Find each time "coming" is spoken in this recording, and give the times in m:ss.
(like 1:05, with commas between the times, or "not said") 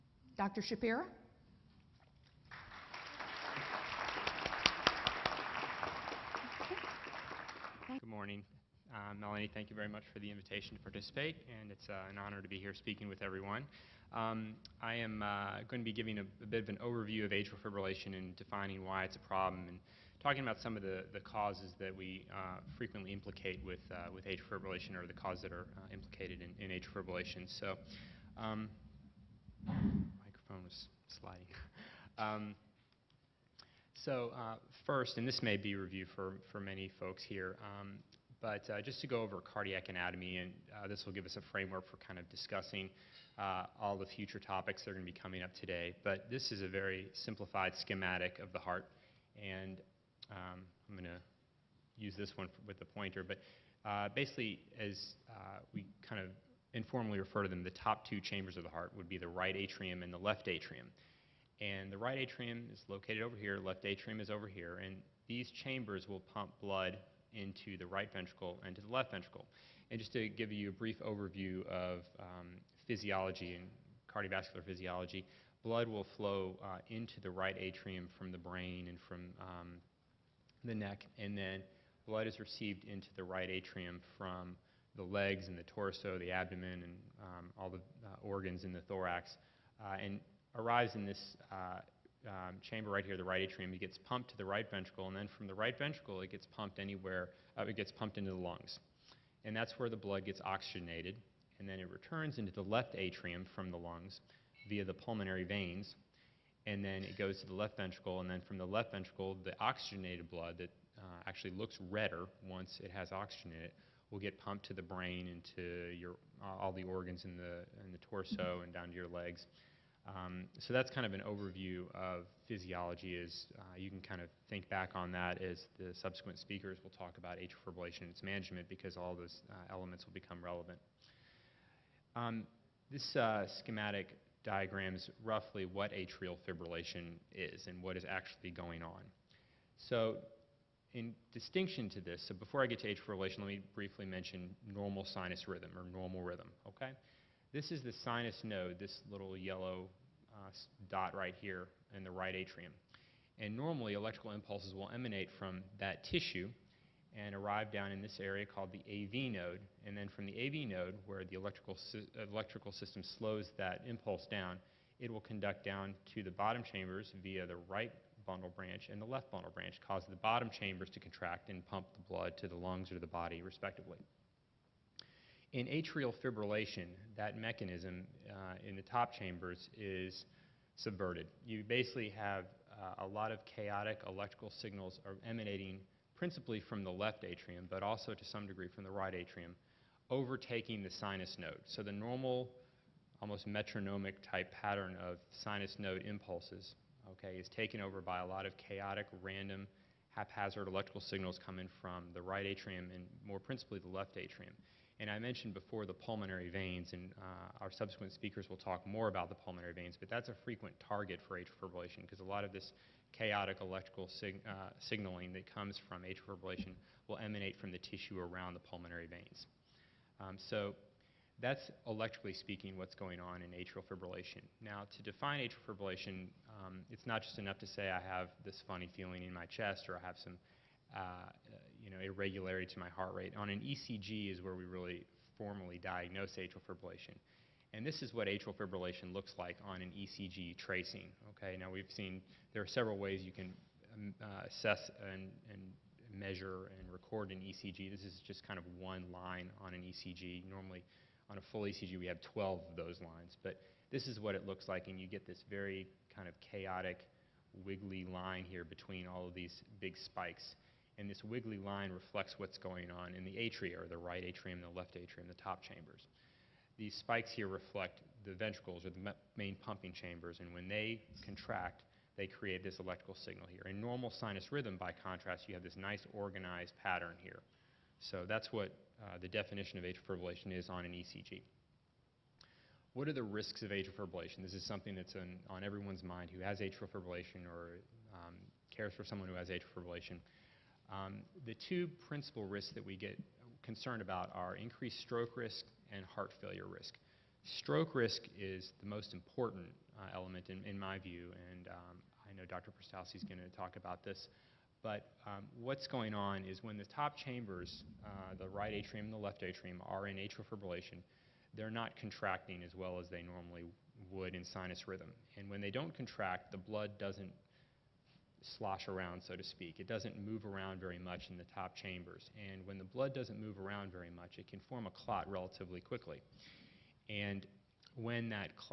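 0:45, 3:21.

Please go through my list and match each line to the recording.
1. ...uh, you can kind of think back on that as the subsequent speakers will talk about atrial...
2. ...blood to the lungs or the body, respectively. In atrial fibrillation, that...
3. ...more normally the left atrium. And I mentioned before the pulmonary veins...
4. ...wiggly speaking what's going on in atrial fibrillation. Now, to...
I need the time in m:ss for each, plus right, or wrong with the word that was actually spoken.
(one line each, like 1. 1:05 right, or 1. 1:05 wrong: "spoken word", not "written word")
1. 2:03 right
2. 2:52 right
3. 3:23 wrong: "principally", not "normally"
4. 3:41 wrong: "electrically", not "wiggly".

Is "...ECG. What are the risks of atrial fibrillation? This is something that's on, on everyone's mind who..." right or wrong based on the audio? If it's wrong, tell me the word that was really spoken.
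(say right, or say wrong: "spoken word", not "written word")
right.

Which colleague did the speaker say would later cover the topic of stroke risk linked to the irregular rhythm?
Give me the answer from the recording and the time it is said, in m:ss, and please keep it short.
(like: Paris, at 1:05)
Dr. Prastowski, at 5:02.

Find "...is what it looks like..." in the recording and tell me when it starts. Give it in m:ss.
4:14.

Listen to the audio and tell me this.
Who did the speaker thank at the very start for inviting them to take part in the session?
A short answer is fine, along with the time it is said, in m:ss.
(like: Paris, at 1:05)
Melanie, at 0:09.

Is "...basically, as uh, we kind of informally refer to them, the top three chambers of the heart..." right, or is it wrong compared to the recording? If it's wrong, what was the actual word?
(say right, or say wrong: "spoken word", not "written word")
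wrong: "two", not "three".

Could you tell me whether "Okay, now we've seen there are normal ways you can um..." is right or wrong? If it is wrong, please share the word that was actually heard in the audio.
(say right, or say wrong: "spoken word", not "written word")
wrong: "several", not "normal".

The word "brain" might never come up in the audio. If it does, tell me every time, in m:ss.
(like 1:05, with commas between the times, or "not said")
1:18, 1:54.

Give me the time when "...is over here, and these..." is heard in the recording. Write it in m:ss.
1:04.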